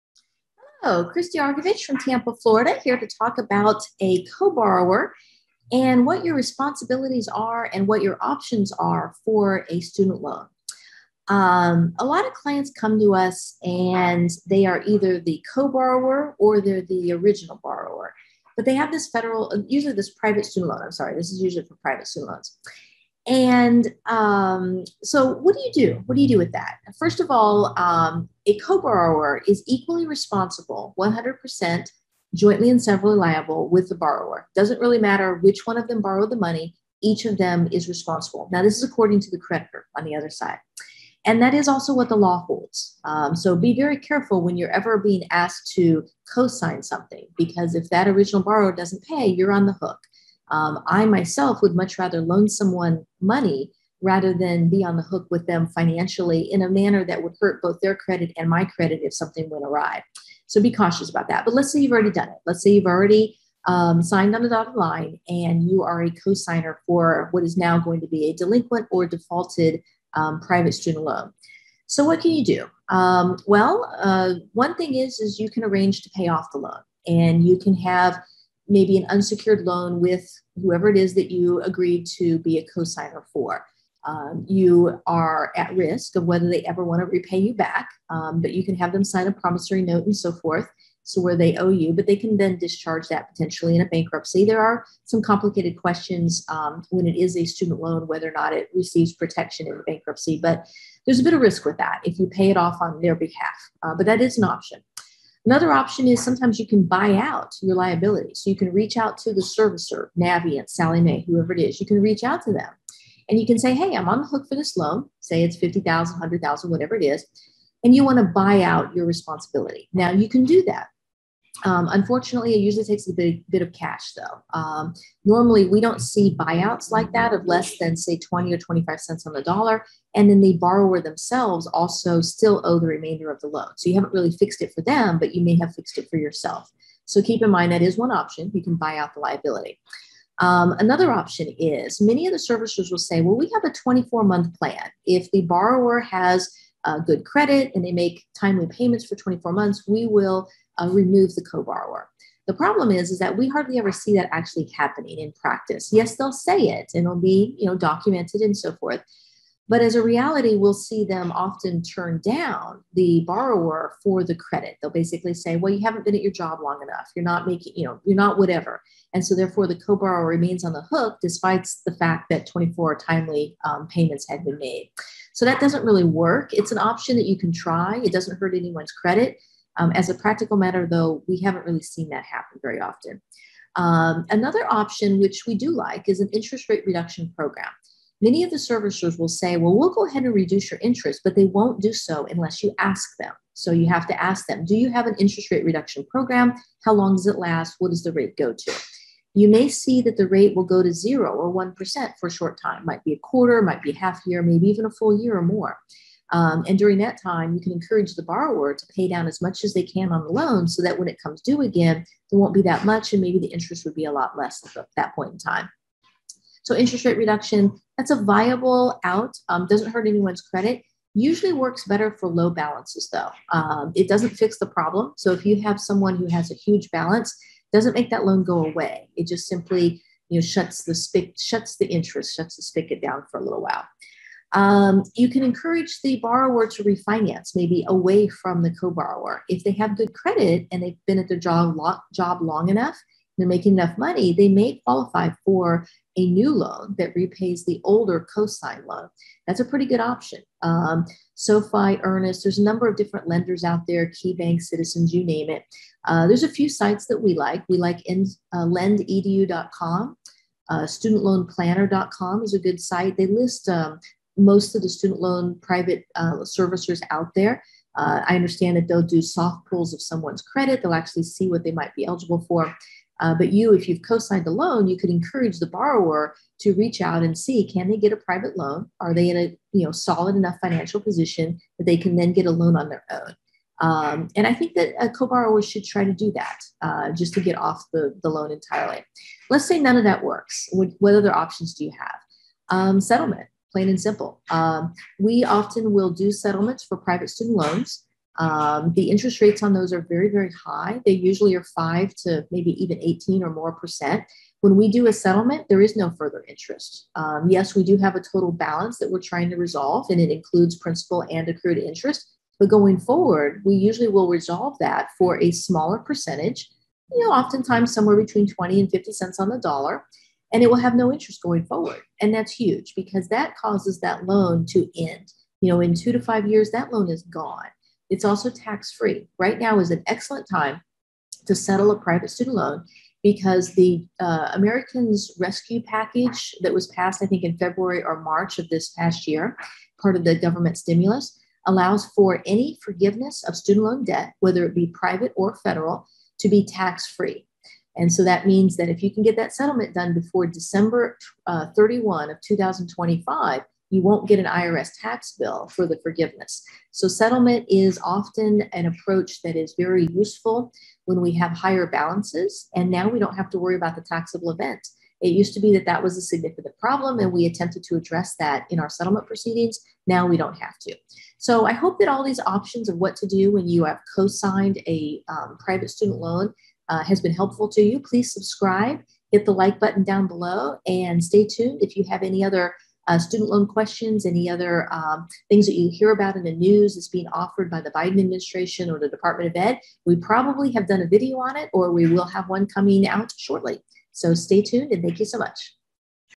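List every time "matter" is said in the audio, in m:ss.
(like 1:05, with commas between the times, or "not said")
0:34, 3:00.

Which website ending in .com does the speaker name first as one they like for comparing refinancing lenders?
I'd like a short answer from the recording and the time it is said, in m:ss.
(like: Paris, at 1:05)
lendedu.com, at 4:18.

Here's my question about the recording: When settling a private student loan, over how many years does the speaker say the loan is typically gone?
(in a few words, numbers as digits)
2 to 5 years.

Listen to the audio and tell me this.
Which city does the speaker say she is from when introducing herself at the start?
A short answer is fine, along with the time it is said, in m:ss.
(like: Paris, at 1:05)
Tampa, at 0:01.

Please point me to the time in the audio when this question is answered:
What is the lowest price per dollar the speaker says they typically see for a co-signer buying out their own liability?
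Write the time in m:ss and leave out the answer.
2:08.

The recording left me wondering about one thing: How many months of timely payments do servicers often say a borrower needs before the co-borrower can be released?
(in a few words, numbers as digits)
24.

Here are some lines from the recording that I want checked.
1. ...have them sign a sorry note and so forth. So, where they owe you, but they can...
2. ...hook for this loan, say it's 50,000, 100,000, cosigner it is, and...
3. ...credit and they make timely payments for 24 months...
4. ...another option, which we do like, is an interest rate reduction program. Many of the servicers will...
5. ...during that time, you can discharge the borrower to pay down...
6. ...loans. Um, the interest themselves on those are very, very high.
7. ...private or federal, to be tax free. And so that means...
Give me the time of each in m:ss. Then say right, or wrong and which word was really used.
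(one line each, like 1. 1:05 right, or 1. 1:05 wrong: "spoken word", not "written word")
1. 1:28 wrong: "promissory", not "sorry"
2. 1:54 wrong: "whatever", not "cosigner"
3. 2:27 right
4. 3:04 right
5. 3:26 wrong: "encourage", not "discharge"
6. 4:57 wrong: "rates", not "themselves"
7. 5:44 right.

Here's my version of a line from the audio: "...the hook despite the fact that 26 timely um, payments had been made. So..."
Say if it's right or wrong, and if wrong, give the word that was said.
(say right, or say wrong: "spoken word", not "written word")
wrong: "24", not "26".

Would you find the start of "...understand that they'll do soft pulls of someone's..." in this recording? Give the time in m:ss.
4:28.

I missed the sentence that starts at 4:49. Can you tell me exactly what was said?
Let's say none of that works.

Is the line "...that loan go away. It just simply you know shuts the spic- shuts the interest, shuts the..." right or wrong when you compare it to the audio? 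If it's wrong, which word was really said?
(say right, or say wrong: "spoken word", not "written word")
right.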